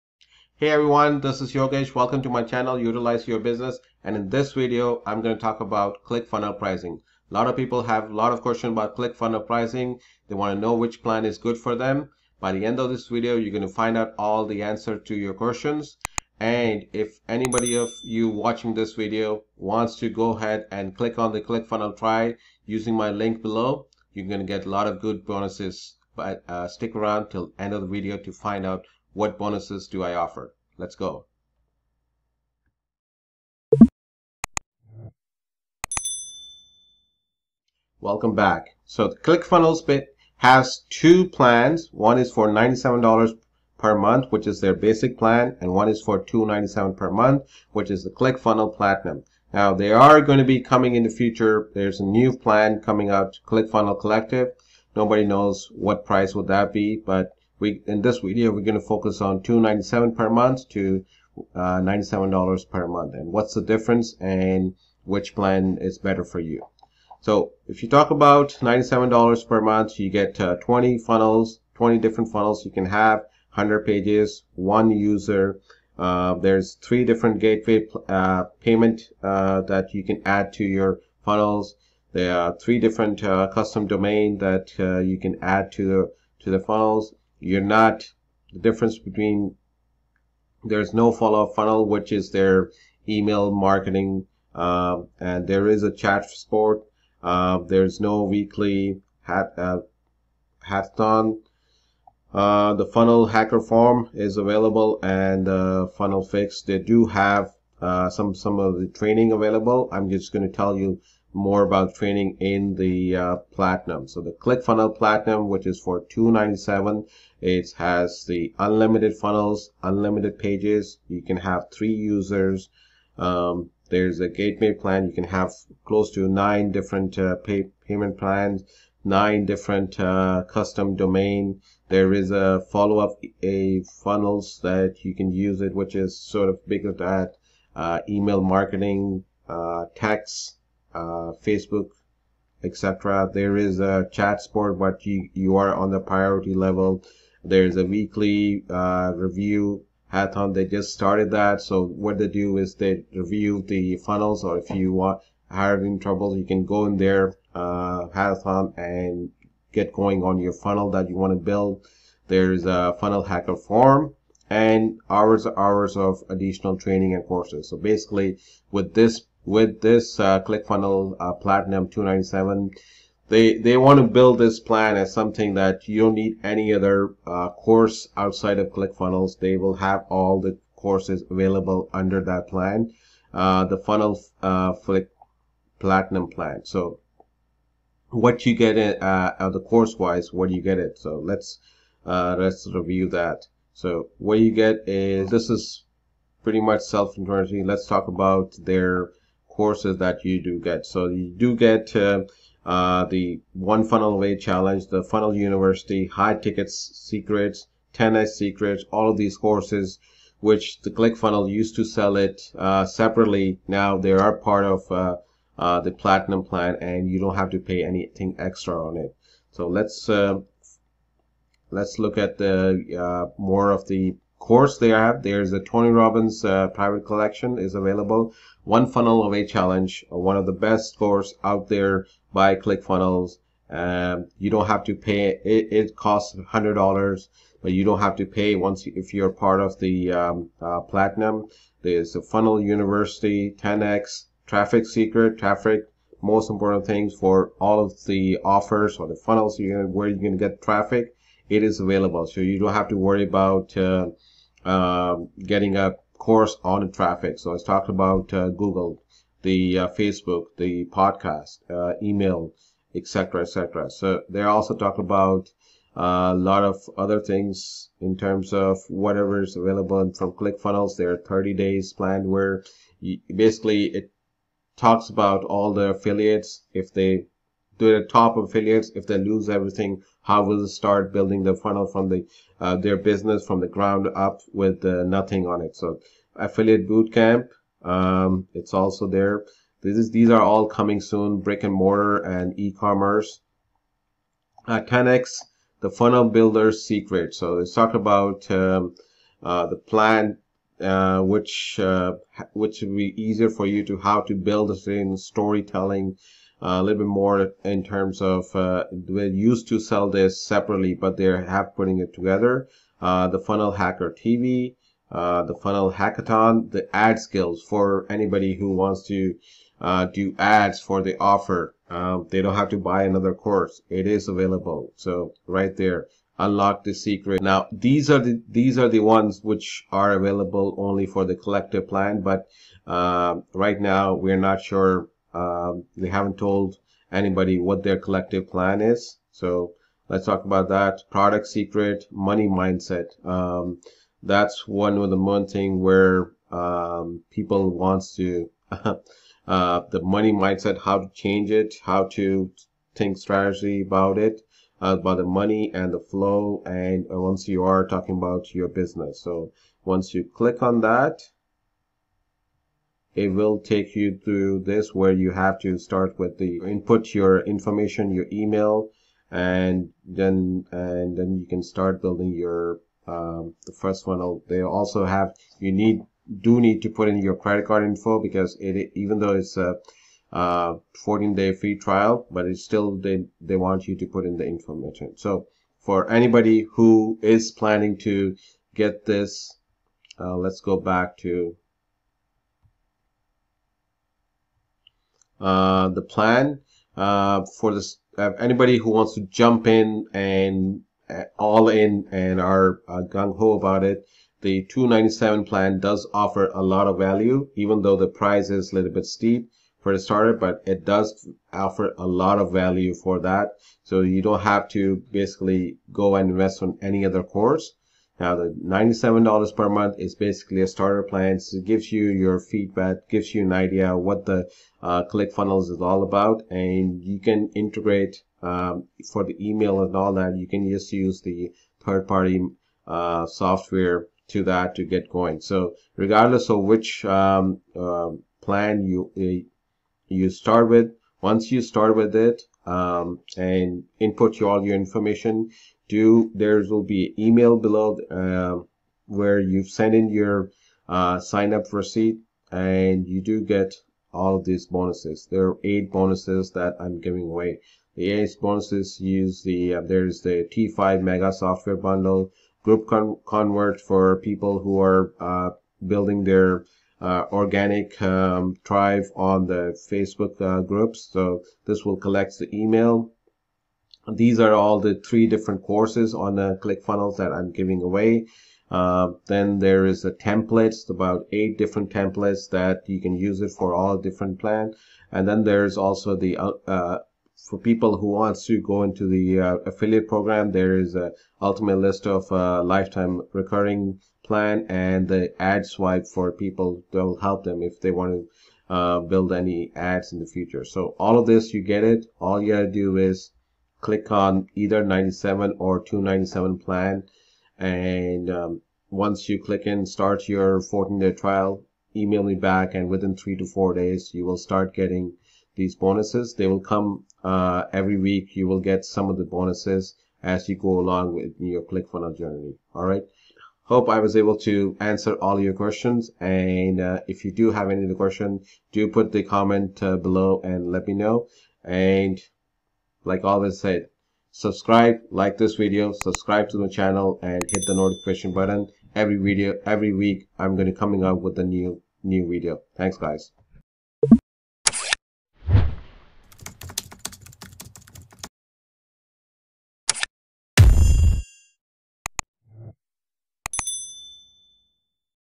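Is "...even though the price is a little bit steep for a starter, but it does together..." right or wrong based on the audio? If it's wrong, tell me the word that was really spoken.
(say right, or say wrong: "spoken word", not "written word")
wrong: "offer", not "together".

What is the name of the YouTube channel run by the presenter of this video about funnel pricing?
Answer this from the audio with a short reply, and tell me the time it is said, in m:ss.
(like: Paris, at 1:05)
Utilize Your Business, at 0:02.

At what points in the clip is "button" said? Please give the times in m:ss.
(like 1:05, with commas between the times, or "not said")
8:58.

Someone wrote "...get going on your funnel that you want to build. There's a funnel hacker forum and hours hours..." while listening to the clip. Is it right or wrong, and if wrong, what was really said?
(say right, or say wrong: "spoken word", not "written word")
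right.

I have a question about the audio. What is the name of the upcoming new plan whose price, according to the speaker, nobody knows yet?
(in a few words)
ClickFunnels Collective.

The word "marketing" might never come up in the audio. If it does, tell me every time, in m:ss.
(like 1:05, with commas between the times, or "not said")
1:33, 2:18.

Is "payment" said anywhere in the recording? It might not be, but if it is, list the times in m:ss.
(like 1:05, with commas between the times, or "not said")
1:18, 2:07.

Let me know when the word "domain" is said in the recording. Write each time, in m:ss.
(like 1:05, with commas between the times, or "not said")
1:23, 2:10.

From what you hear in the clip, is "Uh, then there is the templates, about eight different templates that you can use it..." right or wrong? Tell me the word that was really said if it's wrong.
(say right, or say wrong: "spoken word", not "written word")
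right.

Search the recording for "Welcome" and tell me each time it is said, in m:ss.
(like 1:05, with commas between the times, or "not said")
0:01, 0:37.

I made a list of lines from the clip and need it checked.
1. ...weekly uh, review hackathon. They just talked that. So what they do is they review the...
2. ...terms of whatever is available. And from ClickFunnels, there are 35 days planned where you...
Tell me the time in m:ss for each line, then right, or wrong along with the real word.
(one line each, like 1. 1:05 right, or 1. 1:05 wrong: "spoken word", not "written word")
1. 2:27 wrong: "started", not "talked"
2. 4:28 wrong: "30", not "35".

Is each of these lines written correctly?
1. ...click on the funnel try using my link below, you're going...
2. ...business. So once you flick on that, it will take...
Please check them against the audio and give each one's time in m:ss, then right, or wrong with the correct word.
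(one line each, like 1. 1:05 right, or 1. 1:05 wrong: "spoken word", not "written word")
1. 0:20 right
2. 5:58 wrong: "click", not "flick".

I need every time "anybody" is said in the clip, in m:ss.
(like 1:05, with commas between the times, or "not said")
0:17, 5:18, 5:37, 6:26, 6:38.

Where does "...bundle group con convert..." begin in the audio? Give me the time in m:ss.
7:41.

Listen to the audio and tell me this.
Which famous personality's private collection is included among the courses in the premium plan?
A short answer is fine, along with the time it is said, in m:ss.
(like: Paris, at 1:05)
Tony Robbins, at 3:45.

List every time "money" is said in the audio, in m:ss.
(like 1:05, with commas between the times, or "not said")
5:42, 5:50, 5:55.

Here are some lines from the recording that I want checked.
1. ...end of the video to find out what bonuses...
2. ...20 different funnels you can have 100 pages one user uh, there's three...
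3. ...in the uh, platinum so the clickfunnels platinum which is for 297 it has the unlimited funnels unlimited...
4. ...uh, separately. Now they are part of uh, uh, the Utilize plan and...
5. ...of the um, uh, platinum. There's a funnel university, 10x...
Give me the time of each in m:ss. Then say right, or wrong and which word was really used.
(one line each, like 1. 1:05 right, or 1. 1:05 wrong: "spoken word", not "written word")
1. 0:27 right
2. 1:11 right
3. 1:52 right
4. 3:32 wrong: "Platinum", not "Utilize"
5. 3:59 right.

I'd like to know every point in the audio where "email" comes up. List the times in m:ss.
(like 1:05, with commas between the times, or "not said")
1:33, 2:18, 4:22, 6:08, 7:09, 7:27, 7:52, 8:31.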